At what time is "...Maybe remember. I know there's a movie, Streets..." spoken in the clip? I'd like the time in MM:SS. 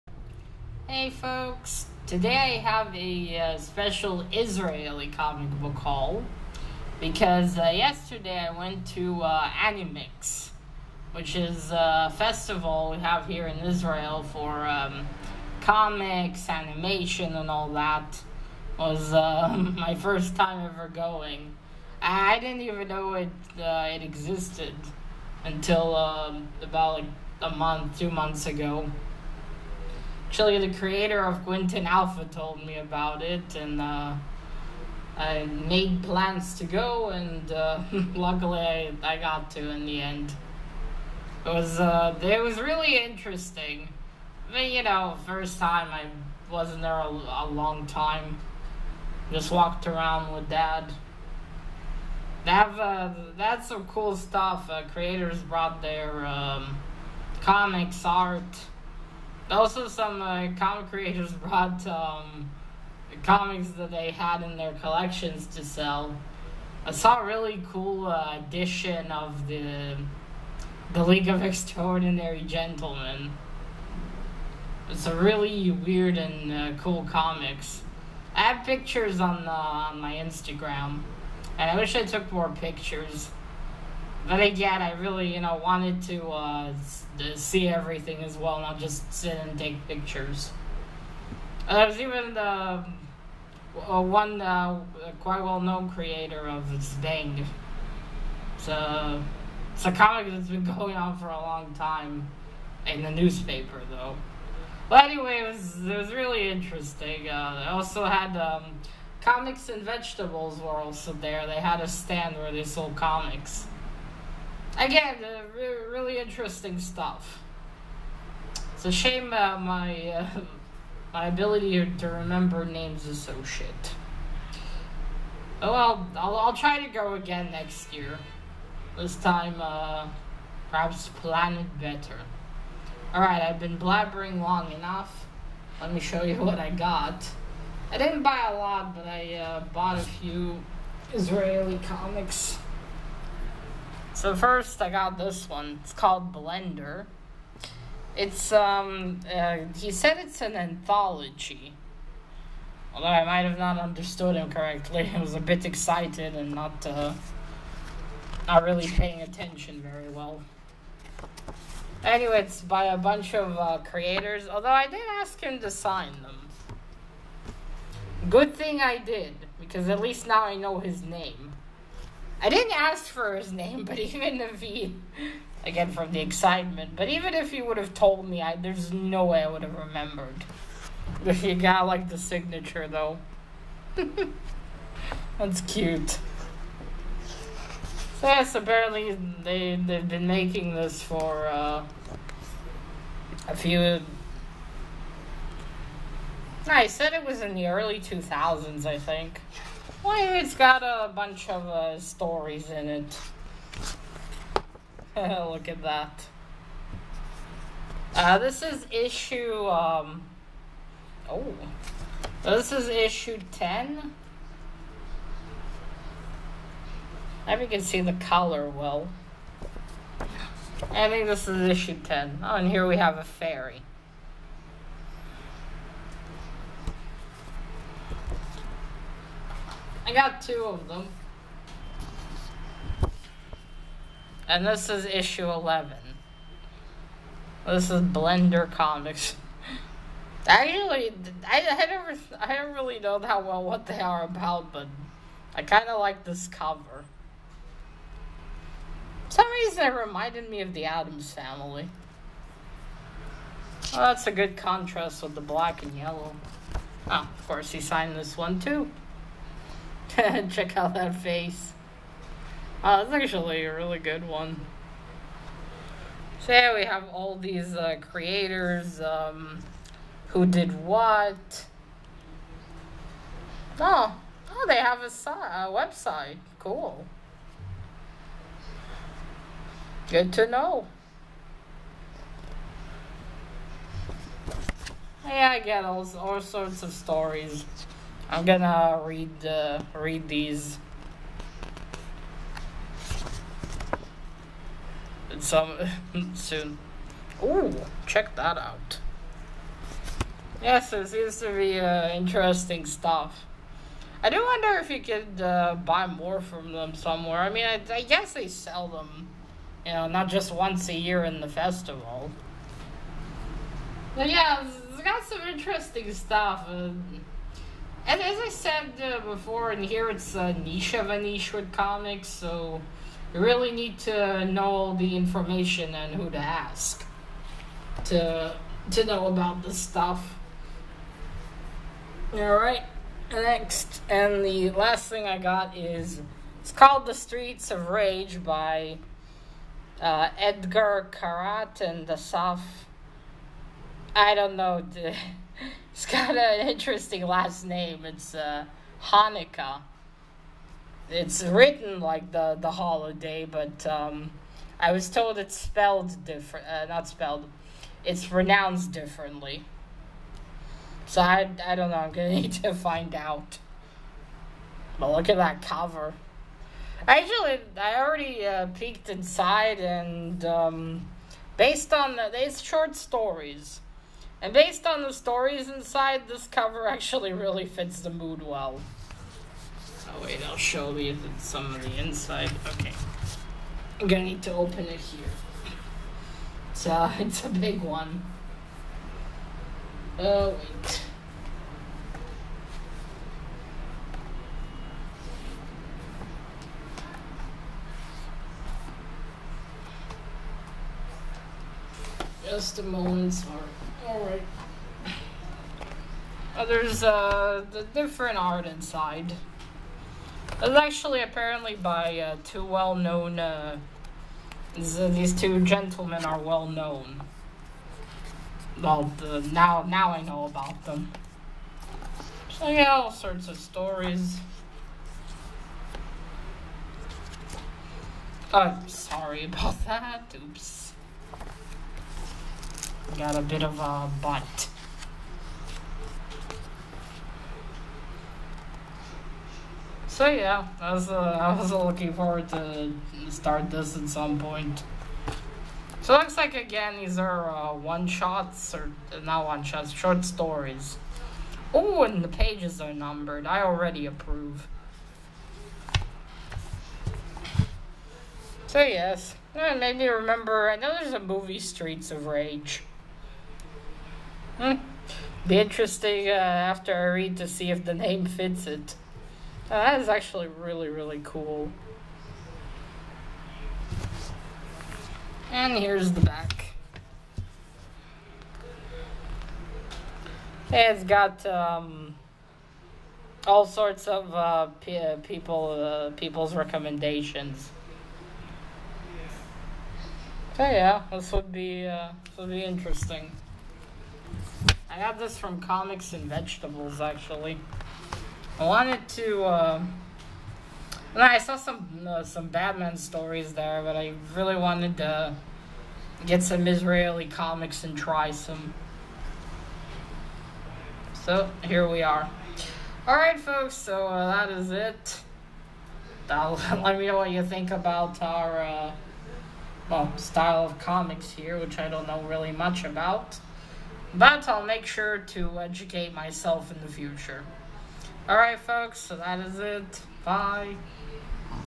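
07:39.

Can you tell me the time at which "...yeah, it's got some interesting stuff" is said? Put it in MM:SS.
05:14.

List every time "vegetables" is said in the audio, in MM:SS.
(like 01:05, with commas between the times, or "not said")
01:49, 08:16.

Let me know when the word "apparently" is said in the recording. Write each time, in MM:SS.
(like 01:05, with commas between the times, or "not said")
03:08, 06:51.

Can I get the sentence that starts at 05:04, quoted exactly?
I do wonder if you could uh, buy more from them somewhere.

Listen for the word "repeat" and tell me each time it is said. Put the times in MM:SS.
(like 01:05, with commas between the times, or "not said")
not said.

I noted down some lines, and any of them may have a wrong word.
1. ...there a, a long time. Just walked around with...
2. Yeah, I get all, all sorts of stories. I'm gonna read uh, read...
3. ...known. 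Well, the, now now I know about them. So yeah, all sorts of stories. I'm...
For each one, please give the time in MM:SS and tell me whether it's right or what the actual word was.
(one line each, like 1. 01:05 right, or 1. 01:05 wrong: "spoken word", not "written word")
1. 00:46 right
2. 04:45 right
3. 06:56 right.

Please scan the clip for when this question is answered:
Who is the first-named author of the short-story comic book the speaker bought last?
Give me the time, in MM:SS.
05:40.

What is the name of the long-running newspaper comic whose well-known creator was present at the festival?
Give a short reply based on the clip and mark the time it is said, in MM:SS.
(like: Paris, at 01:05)
Zbeng, at 01:36.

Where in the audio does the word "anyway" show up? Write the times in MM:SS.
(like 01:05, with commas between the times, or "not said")
01:45, 02:42.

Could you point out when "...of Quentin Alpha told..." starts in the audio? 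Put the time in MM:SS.
00:31.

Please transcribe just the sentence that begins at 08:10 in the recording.
So yeah, this would be uh, this would be interesting.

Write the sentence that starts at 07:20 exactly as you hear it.
So yeah, I was, uh, I was looking forward to start this at some point.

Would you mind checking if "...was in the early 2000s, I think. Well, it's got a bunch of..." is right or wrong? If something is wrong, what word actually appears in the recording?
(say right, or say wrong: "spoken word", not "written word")
right.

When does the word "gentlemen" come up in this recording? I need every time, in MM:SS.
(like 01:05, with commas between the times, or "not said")
01:12, 06:55.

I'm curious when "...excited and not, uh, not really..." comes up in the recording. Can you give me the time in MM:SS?
02:35.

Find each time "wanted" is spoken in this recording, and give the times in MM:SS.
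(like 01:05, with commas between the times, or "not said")
01:25, 08:18, 08:24.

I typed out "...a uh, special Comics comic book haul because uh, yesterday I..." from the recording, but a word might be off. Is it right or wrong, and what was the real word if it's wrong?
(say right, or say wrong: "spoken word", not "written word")
wrong: "Israeli", not "Comics".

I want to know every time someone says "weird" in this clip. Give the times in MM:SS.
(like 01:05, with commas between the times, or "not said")
01:15.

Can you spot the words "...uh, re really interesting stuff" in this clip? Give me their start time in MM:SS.
01:55.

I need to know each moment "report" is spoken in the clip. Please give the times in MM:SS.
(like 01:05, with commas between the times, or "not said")
not said.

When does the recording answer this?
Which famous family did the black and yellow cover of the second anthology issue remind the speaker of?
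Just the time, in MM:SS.
04:10.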